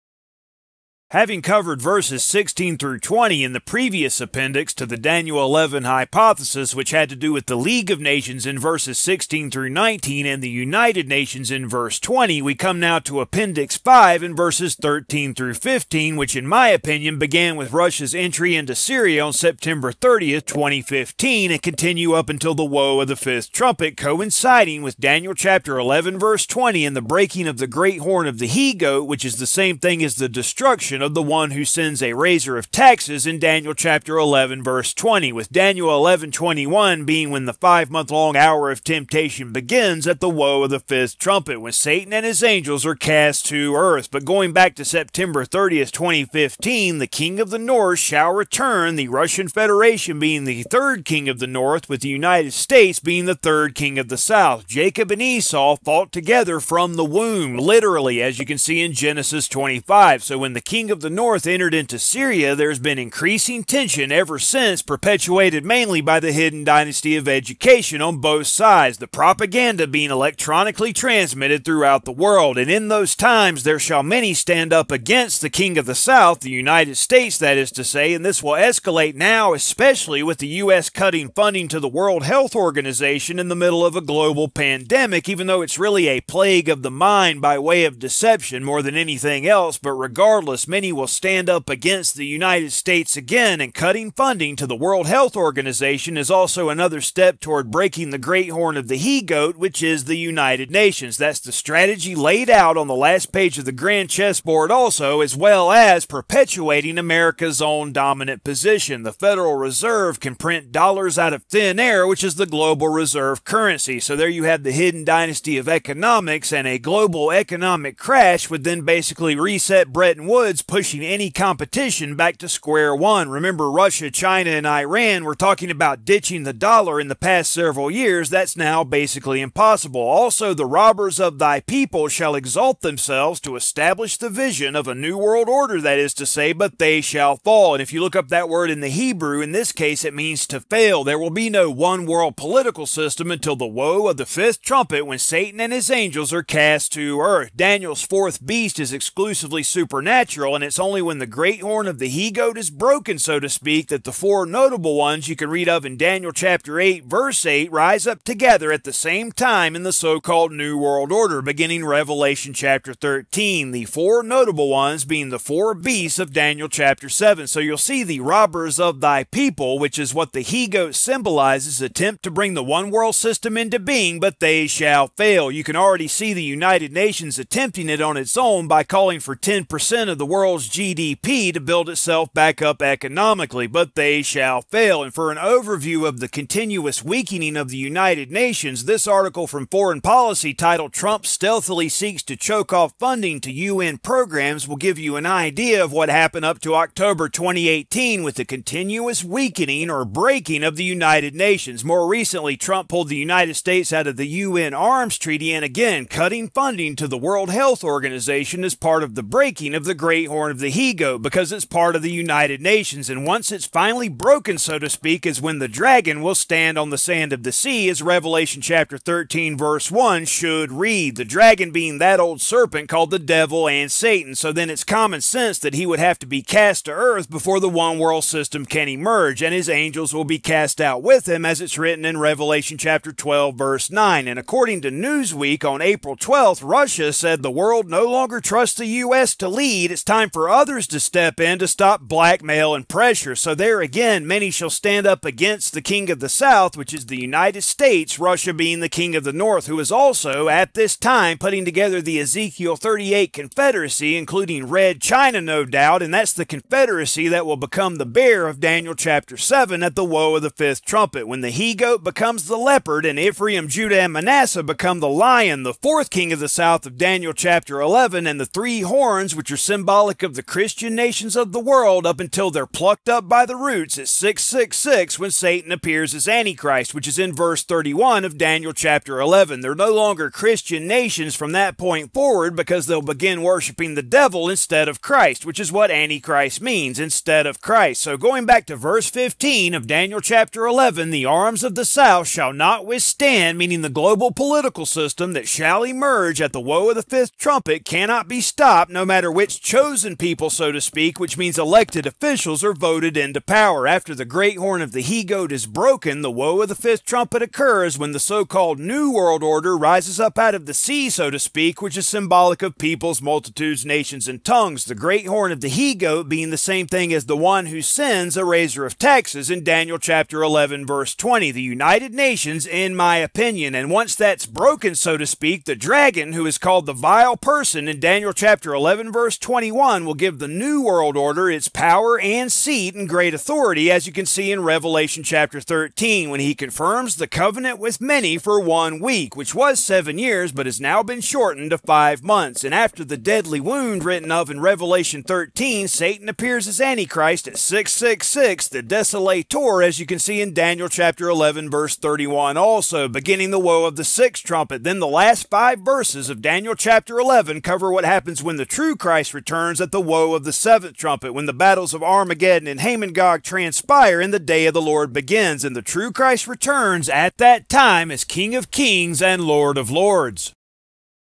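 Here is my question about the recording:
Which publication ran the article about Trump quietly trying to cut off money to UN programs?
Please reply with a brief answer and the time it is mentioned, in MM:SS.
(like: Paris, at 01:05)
Foreign Policy, at 03:09.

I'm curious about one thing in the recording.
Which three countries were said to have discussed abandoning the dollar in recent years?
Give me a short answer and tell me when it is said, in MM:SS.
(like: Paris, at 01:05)
Russia, China, and Iran, at 02:03.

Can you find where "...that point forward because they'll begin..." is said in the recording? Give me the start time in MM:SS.
04:41.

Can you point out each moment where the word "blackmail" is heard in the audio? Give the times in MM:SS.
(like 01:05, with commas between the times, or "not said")
04:02.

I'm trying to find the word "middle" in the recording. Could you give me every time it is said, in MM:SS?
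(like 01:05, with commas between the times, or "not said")
01:23.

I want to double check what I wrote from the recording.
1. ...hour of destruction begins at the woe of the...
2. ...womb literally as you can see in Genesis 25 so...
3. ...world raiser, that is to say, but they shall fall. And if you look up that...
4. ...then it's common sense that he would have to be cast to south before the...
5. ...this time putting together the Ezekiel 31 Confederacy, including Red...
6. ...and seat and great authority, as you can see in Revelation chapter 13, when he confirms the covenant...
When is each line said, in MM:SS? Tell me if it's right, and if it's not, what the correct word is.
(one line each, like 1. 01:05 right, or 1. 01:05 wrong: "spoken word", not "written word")
1. 00:38 wrong: "temptation", not "destruction"
2. 00:57 right
3. 02:15 wrong: "order", not "raiser"
4. 03:44 wrong: "earth", not "south"
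5. 04:10 wrong: "38", not "31"
6. 05:32 right.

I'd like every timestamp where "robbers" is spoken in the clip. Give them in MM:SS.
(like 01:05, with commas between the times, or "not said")
02:10, 02:48.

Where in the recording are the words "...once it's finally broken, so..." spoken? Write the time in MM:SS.
03:33.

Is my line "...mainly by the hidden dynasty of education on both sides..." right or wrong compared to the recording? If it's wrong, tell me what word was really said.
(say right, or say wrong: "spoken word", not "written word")
right.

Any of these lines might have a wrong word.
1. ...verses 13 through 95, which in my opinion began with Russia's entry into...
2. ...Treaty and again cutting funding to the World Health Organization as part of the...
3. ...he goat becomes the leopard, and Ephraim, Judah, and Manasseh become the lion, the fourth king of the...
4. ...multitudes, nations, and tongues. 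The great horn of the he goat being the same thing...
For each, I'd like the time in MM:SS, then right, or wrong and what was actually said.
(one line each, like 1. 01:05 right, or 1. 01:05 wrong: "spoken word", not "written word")
1. 00:14 wrong: "15", not "95"
2. 03:25 right
3. 04:21 right
4. 05:13 right.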